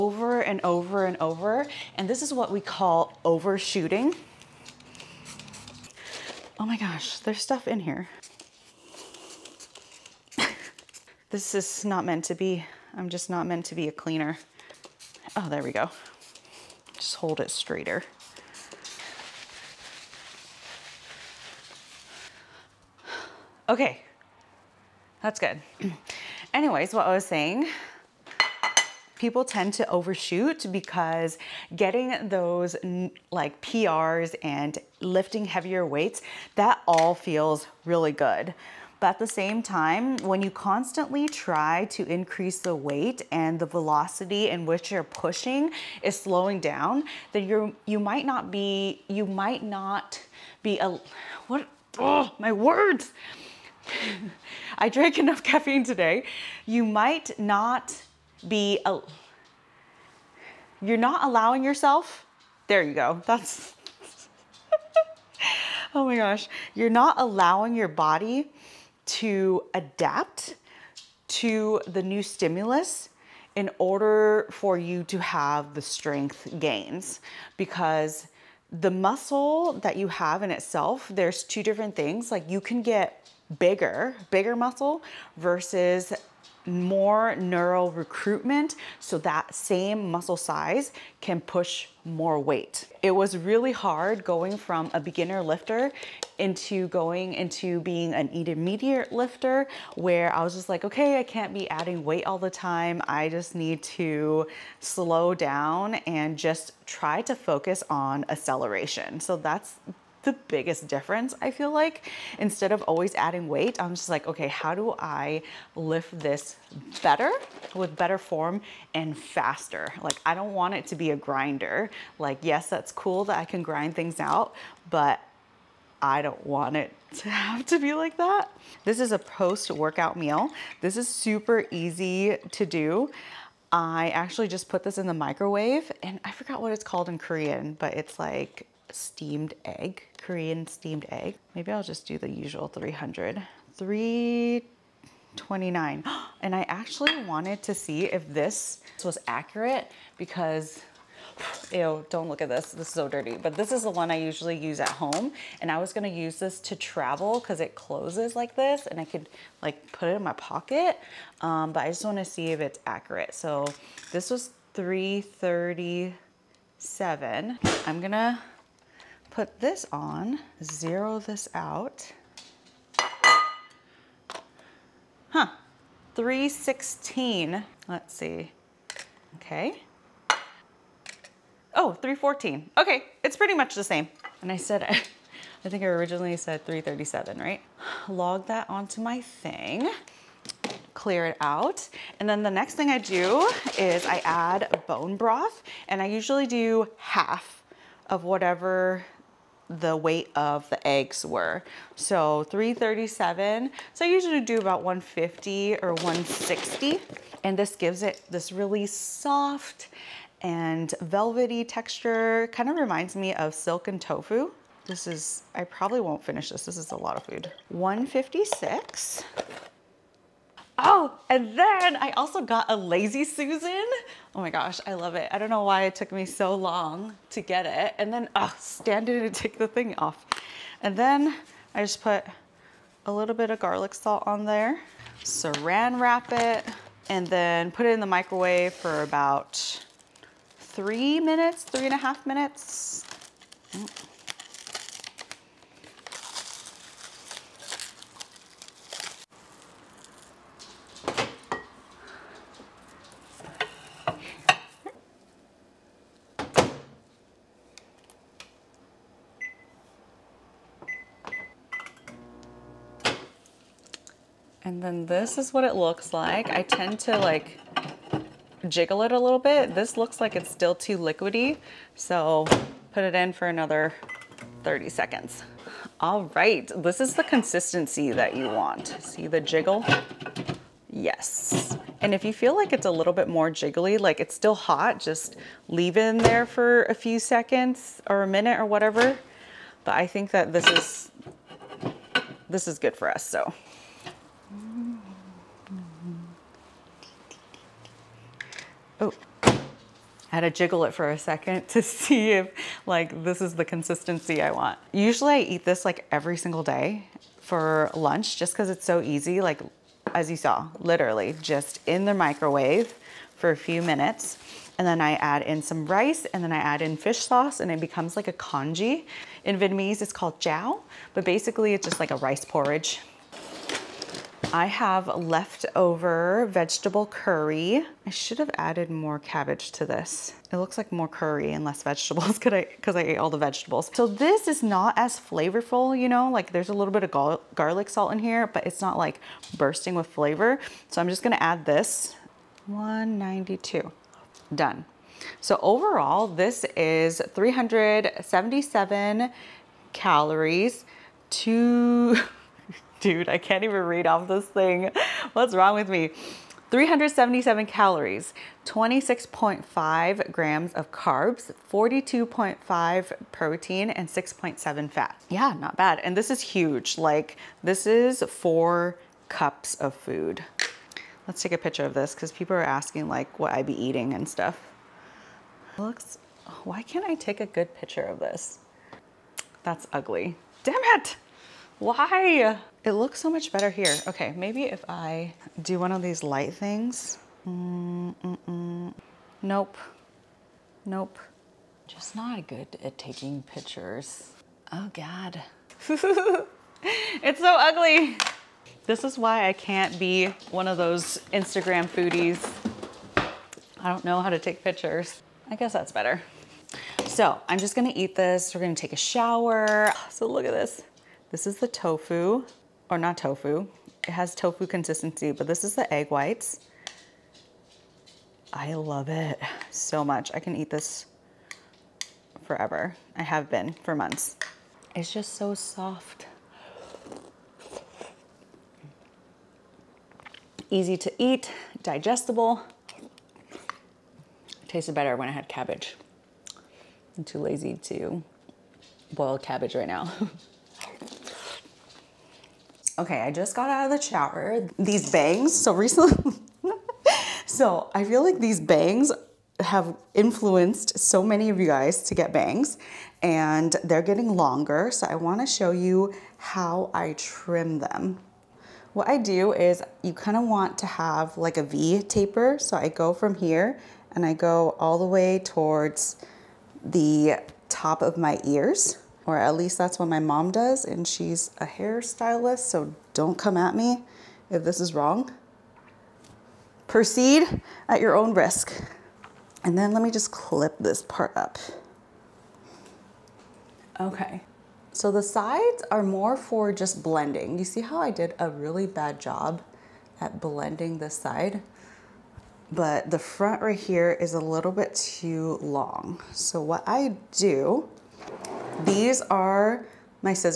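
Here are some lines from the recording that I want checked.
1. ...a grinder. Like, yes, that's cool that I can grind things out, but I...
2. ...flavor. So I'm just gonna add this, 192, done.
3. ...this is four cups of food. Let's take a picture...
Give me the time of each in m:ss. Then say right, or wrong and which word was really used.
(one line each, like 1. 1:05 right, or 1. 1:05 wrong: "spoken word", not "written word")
1. 2:01 right
2. 5:40 right
3. 6:07 right.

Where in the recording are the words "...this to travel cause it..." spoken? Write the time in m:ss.
2:36.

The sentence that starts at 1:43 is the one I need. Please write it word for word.
I just need to slow down and just try to focus on acceleration.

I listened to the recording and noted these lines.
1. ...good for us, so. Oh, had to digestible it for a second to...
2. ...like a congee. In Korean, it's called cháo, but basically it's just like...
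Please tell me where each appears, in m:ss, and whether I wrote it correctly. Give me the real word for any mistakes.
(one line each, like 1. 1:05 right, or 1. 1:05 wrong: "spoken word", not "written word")
1. 4:52 wrong: "jiggle", not "digestible"
2. 5:18 wrong: "Vietnamese", not "Korean".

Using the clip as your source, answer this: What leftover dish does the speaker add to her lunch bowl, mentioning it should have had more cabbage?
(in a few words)
vegetable curry.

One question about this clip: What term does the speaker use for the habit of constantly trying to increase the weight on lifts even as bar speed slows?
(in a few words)
overshooting.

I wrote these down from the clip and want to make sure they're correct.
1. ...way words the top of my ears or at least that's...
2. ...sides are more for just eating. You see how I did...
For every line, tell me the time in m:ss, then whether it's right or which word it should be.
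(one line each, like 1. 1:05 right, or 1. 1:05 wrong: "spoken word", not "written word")
1. 7:45 wrong: "towards", not "words"
2. 8:05 wrong: "blending", not "eating".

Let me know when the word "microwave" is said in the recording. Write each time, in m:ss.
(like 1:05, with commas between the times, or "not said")
2:15, 3:58, 5:12.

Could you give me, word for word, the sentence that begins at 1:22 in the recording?
Like you can get bigger, bigger muscle versus more neural recruitment so that same muscle size can push more weight.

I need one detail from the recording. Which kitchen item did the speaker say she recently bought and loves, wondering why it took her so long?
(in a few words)
Lazy Susan.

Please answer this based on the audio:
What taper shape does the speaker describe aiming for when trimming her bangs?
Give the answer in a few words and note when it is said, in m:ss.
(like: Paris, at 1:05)
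V taper, at 7:41.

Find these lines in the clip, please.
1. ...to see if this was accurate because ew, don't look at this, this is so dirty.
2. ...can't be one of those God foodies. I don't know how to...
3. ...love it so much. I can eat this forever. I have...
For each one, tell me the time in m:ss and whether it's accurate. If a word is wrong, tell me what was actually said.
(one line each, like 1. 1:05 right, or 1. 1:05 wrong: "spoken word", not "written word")
1. 2:27 right
2. 6:39 wrong: "Instagram", not "God"
3. 6:58 right.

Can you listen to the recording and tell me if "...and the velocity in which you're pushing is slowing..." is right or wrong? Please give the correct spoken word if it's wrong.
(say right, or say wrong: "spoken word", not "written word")
right.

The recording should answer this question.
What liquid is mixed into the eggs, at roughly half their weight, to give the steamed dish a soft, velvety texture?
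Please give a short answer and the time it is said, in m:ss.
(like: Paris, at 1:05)
bone broth, at 3:14.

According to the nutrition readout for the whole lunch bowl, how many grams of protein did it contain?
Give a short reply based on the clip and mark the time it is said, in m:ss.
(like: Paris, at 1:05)
42.5, at 6:01.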